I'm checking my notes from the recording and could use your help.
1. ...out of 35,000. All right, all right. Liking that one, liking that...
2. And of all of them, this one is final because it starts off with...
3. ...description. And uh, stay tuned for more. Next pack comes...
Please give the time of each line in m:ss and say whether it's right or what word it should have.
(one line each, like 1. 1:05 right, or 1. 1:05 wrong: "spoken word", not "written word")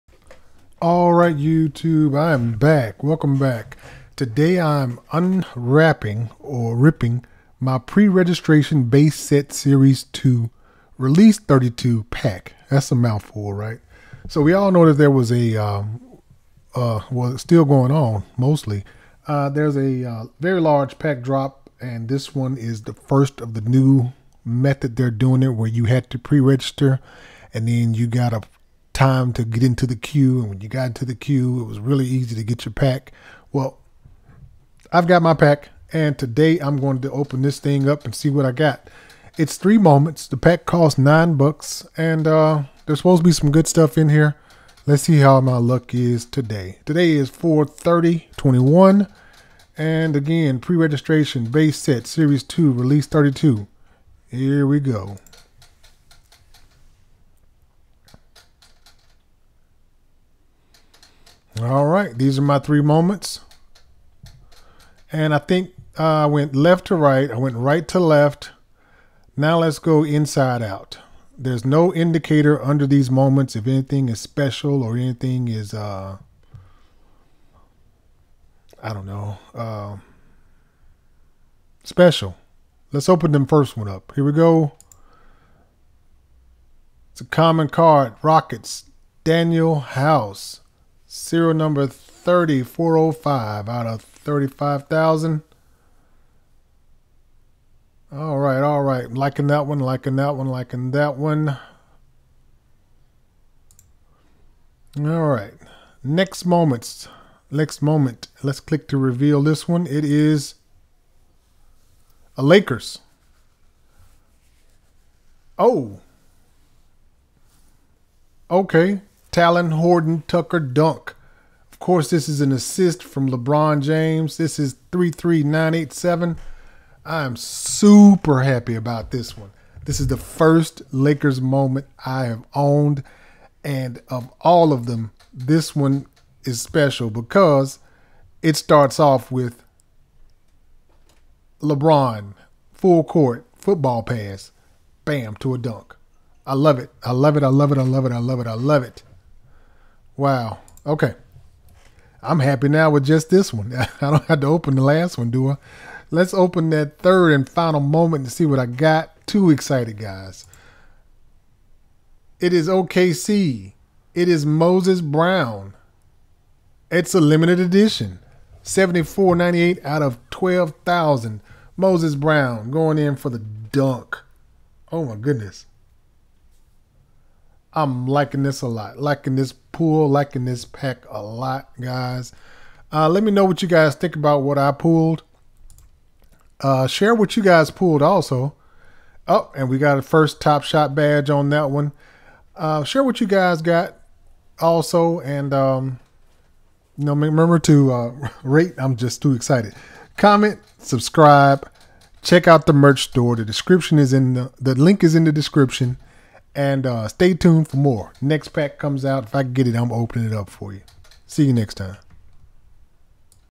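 1. 1:33 right
2. 2:13 wrong: "special", not "final"
3. 3:25 right.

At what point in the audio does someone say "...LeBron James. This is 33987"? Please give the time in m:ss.
2:03.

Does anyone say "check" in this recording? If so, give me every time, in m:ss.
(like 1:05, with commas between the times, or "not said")
3:22.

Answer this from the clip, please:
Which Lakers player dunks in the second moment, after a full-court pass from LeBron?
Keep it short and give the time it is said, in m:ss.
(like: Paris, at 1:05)
Talen Horton Tucker, at 1:59.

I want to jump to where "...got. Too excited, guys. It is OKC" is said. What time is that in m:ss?
2:38.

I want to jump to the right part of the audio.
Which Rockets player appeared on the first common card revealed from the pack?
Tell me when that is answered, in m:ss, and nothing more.
1:29.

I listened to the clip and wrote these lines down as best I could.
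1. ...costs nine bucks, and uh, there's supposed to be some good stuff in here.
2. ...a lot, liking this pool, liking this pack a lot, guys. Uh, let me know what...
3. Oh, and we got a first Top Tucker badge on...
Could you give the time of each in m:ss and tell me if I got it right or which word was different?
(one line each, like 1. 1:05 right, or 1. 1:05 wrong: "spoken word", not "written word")
1. 0:40 right
2. 2:58 right
3. 3:09 wrong: "Shot", not "Tucker".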